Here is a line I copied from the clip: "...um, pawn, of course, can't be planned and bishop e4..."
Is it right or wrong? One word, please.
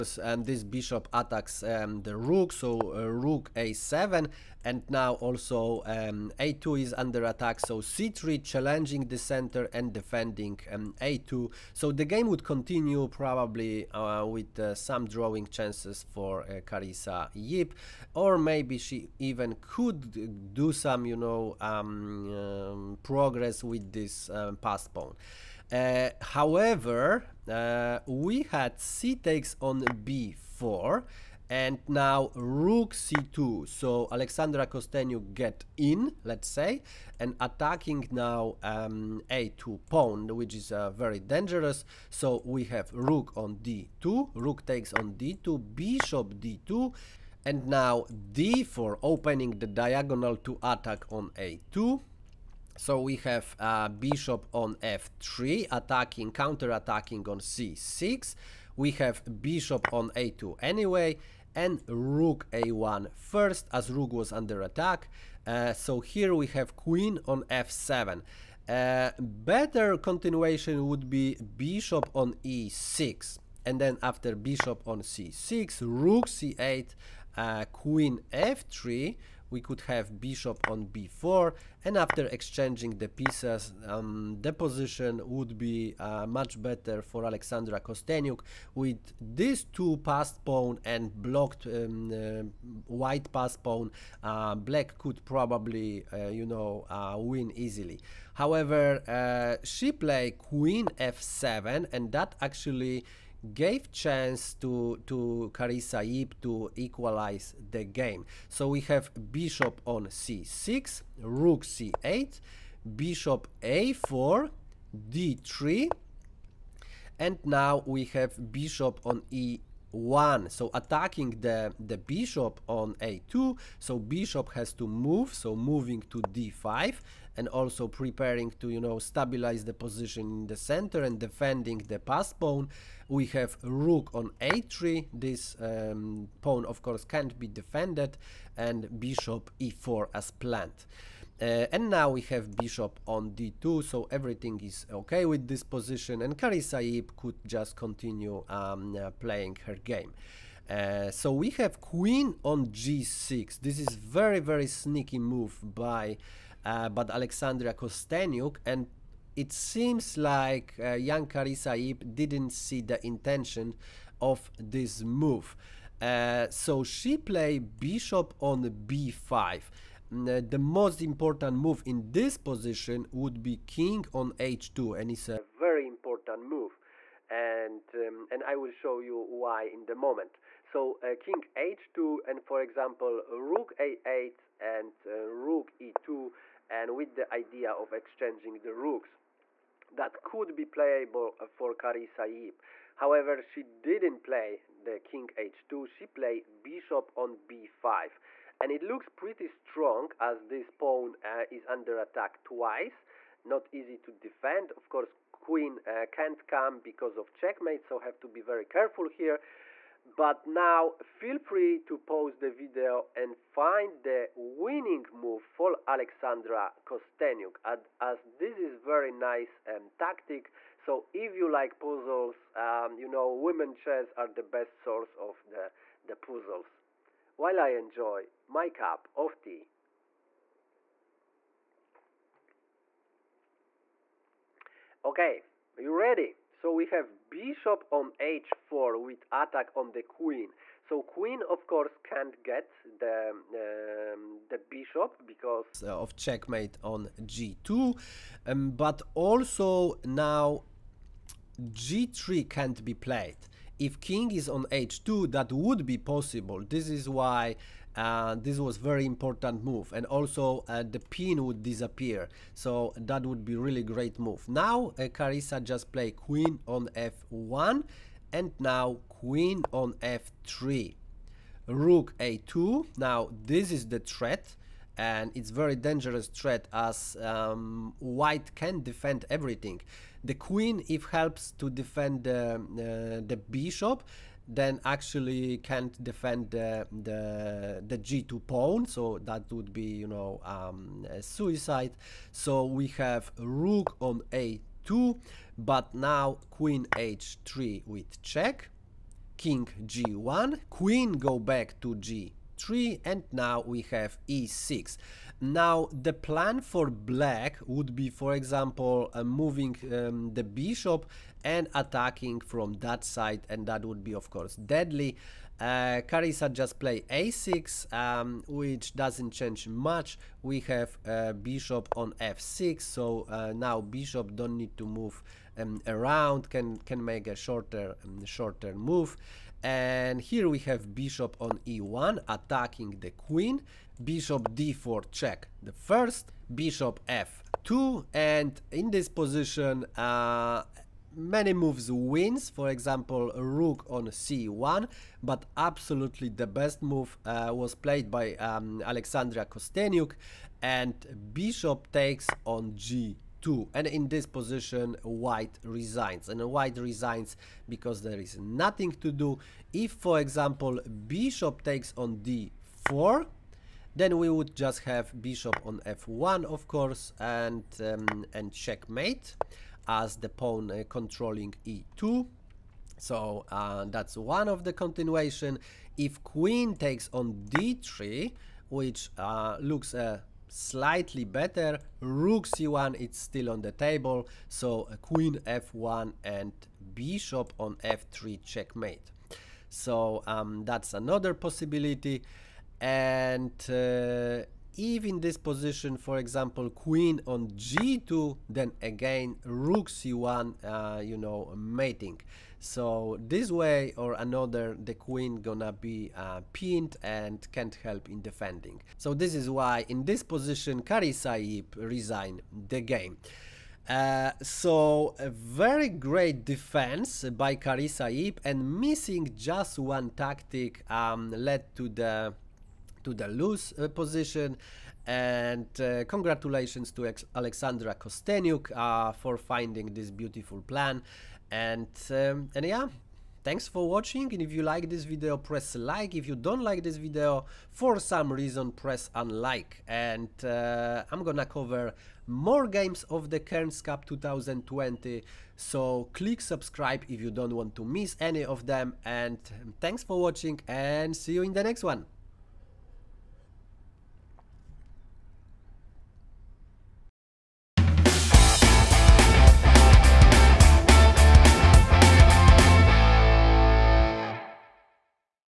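wrong.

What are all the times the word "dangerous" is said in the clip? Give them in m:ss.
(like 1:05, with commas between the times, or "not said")
0:41, 4:35.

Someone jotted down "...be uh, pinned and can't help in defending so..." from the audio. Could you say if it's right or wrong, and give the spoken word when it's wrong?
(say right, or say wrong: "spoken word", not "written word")
right.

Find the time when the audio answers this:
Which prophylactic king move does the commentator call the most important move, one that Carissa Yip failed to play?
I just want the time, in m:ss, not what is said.
2:53.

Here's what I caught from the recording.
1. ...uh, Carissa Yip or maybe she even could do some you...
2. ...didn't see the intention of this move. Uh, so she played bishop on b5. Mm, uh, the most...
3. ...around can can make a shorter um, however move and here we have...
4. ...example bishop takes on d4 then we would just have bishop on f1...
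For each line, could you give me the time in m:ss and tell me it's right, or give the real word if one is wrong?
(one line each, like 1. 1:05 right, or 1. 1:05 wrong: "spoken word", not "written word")
1. 0:16 right
2. 2:42 right
3. 5:25 wrong: "shorter", not "however"
4. 6:00 right.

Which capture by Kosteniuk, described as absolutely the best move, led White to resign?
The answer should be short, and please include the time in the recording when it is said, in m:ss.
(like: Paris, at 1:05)
Bishop takes g2, at 5:51.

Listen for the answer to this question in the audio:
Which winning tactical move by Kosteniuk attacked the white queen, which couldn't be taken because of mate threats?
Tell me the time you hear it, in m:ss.
3:57.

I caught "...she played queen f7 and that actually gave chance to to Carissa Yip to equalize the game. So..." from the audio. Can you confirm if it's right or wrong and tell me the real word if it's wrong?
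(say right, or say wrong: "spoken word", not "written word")
right.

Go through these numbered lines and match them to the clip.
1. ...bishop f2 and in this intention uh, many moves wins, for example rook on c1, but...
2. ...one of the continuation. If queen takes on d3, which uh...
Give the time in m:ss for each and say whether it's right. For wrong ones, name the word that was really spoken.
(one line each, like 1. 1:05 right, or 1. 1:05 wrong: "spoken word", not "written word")
1. 5:36 wrong: "position", not "intention"
2. 6:14 right.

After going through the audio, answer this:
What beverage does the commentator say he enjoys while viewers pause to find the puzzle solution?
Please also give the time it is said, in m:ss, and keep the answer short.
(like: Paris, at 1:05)
Tea, at 3:48.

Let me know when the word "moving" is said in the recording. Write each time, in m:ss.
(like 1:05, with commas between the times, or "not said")
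2:05, 5:09.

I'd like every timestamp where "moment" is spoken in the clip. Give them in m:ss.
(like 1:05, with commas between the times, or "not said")
2:59.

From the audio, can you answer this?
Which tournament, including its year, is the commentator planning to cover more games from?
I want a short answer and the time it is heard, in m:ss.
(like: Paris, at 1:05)
Cairns Cup 2020, at 7:23.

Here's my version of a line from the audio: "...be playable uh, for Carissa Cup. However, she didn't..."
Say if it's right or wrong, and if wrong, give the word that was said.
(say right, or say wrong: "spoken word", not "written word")
wrong: "Yip", not "Cup".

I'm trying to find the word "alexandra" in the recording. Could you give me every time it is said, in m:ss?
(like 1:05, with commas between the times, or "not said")
0:34, 1:27, 2:37, 3:35, 5:48, 7:07.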